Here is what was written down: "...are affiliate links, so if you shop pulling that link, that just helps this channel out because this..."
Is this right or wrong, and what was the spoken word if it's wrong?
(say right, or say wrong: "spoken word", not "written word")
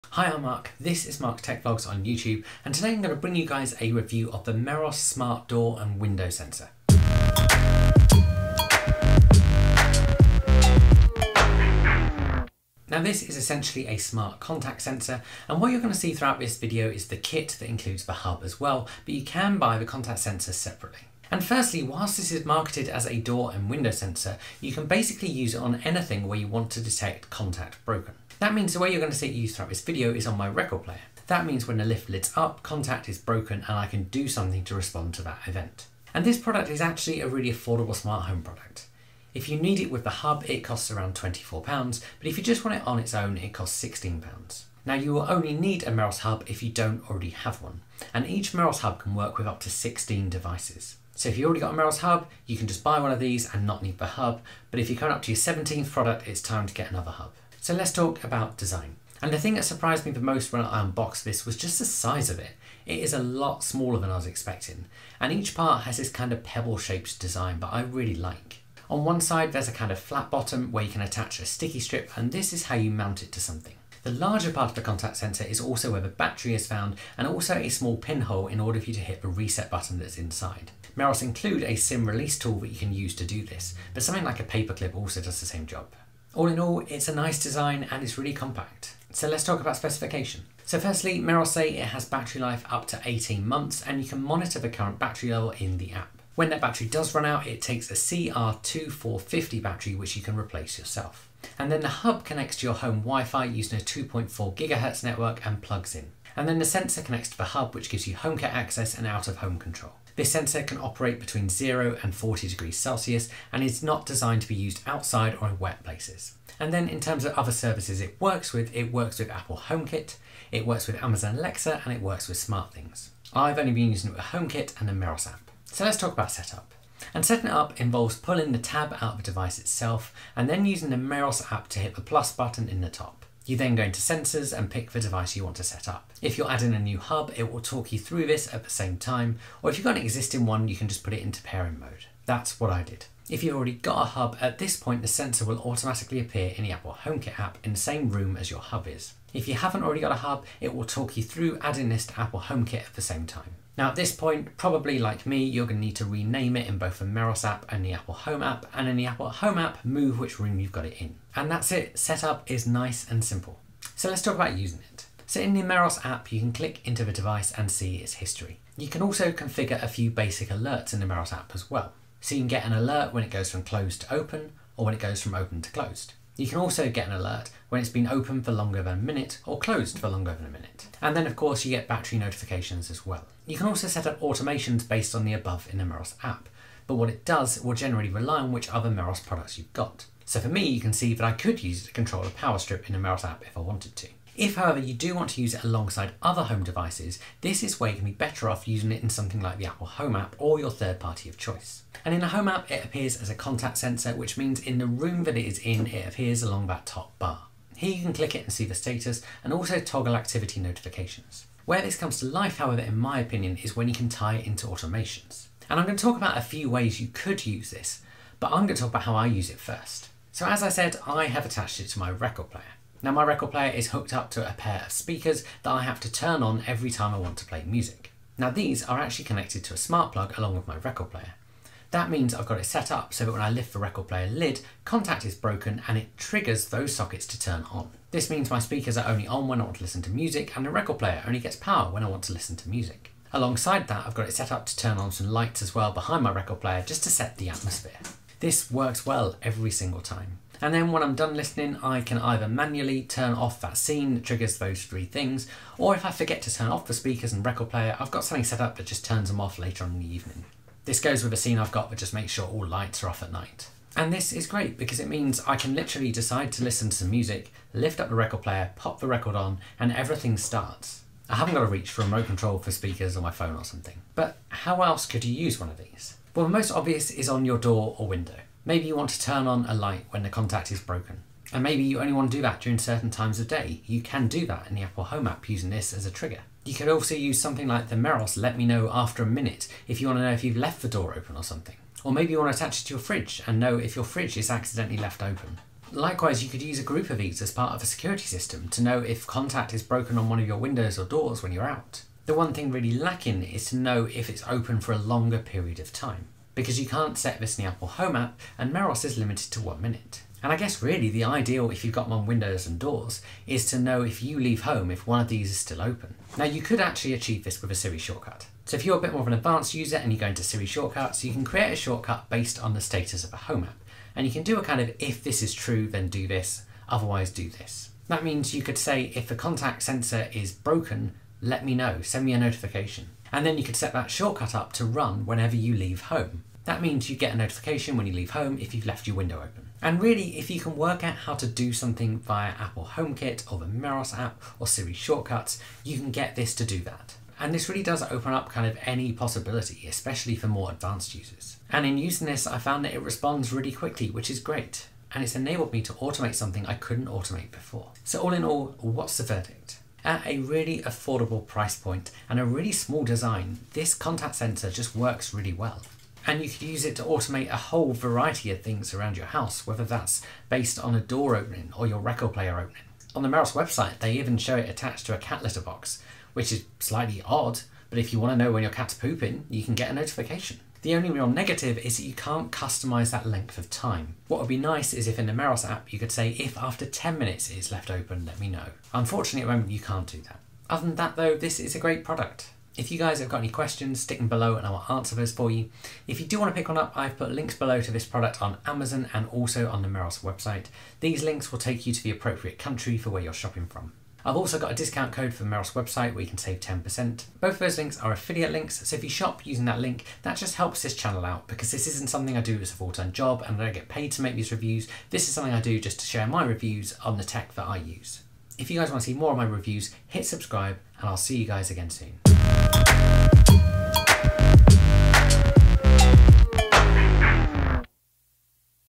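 wrong: "using", not "pulling".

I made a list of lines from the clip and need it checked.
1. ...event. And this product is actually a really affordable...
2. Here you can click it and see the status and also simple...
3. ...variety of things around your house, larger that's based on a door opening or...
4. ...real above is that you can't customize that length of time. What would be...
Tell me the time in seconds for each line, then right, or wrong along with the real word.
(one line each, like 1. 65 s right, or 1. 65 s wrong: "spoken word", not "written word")
1. 35 s right
2. 207 s wrong: "toggle", not "simple"
3. 367 s wrong: "whether", not "larger"
4. 381 s wrong: "negative", not "above".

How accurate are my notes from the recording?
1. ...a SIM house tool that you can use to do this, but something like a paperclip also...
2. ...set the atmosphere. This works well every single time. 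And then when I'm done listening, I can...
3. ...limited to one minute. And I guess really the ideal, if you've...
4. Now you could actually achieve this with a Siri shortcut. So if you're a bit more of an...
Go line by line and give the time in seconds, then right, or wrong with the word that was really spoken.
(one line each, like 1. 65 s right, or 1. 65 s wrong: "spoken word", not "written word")
1. 81 s wrong: "release", not "house"
2. 247 s right
3. 309 s right
4. 316 s right.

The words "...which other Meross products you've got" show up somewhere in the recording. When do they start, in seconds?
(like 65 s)
188 s.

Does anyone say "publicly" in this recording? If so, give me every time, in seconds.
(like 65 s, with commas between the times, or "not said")
not said.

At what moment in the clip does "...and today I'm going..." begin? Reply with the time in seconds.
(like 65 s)
2 s.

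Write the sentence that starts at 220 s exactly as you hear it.
So as I said, I have attached it to my record player.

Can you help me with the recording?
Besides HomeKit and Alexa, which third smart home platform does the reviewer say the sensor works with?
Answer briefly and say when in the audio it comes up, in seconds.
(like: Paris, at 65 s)
SmartThings, at 122 s.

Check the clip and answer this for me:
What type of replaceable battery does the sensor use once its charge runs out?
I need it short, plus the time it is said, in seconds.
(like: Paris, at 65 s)
CR2450, at 97 s.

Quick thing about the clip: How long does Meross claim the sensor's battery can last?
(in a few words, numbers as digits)
18 months.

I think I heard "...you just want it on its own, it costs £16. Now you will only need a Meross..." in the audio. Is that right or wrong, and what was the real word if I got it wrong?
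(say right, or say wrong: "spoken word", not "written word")
right.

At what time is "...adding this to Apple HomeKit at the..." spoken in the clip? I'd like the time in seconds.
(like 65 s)
151 s.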